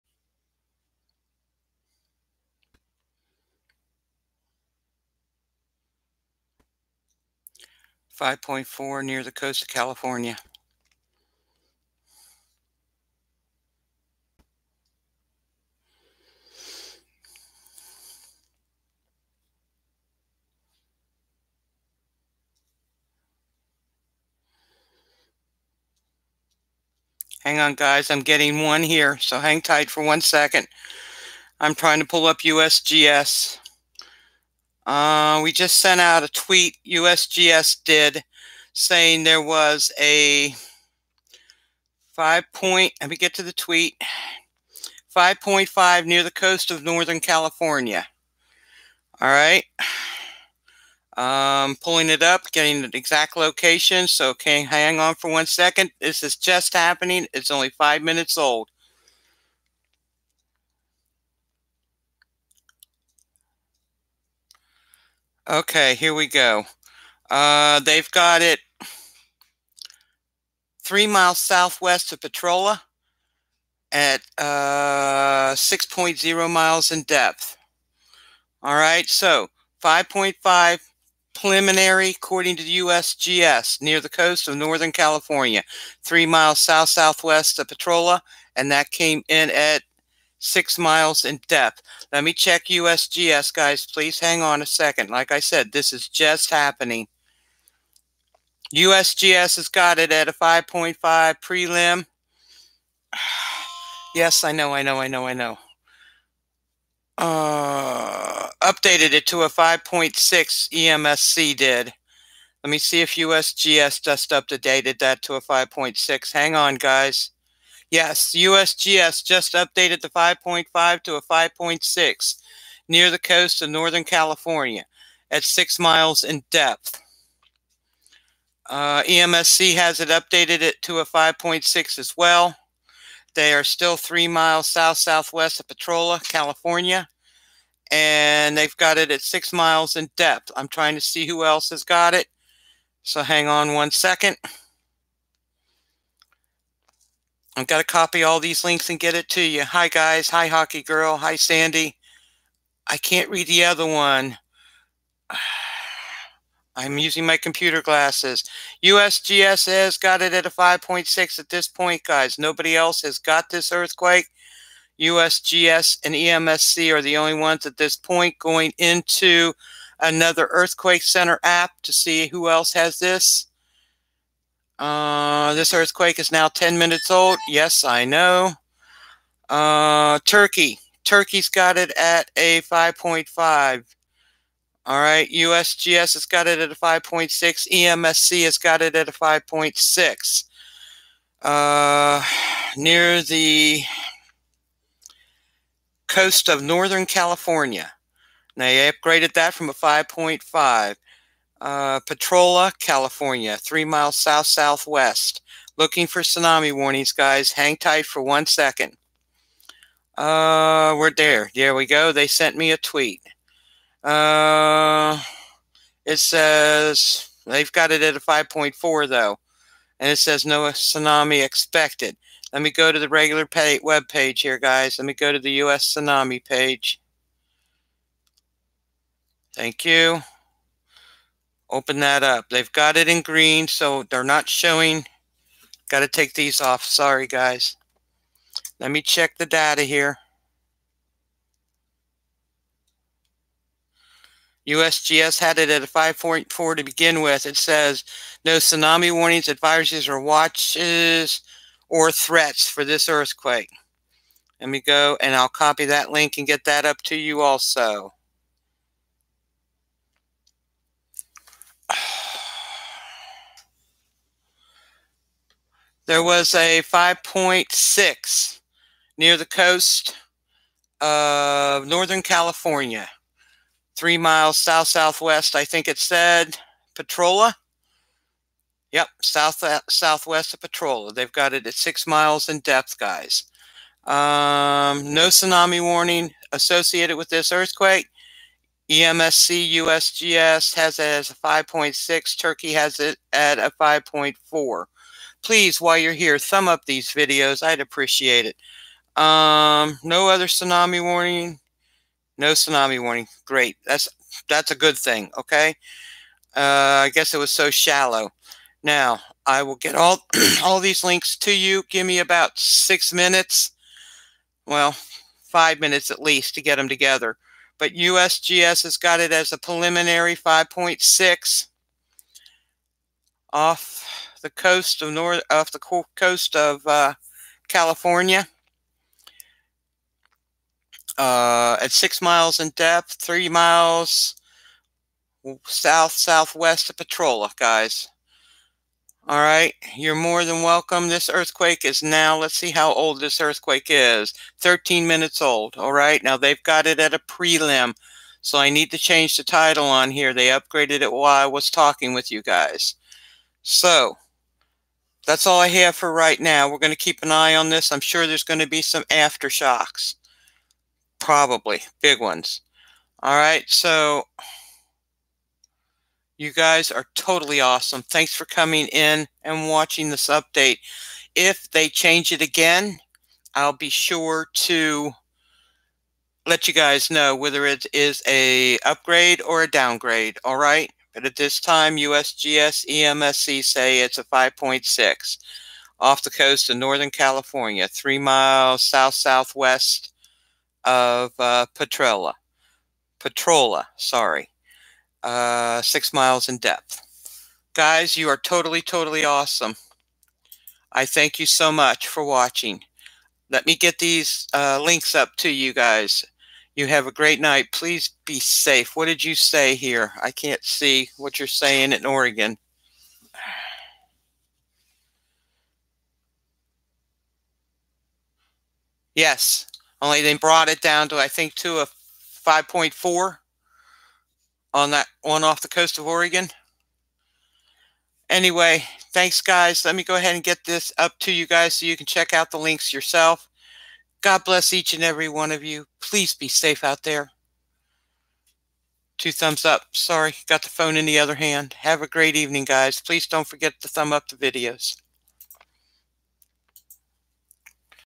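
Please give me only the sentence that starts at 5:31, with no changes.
Uh, at six miles in depth, three miles south southwest of Petrolia, guys.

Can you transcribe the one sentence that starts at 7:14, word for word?
God bless each and every one of you please be safe out there.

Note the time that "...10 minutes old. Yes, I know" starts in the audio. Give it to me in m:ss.
2:56.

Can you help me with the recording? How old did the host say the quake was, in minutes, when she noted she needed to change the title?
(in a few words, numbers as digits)
13.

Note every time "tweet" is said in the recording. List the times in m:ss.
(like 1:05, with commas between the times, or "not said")
0:36, 0:43, 3:32.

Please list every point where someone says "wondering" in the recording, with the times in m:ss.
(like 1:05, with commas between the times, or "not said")
not said.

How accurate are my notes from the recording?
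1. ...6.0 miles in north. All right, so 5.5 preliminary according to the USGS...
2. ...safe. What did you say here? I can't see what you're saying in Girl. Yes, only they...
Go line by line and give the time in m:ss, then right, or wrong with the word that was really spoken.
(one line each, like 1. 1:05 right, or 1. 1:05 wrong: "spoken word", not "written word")
1. 1:15 wrong: "depth", not "north"
2. 6:48 wrong: "Oregon", not "Girl".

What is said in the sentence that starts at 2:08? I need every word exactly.
Uh, EMSC has it updated it to a 5.6 as well.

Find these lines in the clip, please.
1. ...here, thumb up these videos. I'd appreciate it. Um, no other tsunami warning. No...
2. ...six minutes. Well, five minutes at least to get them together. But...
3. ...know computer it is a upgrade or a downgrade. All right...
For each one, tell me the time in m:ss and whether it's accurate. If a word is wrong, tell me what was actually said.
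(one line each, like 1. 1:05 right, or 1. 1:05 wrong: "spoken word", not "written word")
1. 4:56 right
2. 5:12 right
3. 6:17 wrong: "whether", not "computer".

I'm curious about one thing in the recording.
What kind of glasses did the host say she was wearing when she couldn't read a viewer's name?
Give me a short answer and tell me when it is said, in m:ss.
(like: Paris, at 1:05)
Computer glasses, at 2:37.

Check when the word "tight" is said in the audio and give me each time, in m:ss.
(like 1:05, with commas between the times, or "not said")
0:29, 3:27.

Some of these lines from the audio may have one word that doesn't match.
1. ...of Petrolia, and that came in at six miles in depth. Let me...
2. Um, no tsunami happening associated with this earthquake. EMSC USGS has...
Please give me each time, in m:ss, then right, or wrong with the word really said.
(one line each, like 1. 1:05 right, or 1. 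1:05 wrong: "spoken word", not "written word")
1. 1:27 right
2. 4:44 wrong: "warning", not "happening".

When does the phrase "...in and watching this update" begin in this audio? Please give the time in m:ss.
6:08.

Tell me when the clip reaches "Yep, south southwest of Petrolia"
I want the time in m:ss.
4:38.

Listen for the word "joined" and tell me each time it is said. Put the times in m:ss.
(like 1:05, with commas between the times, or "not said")
not said.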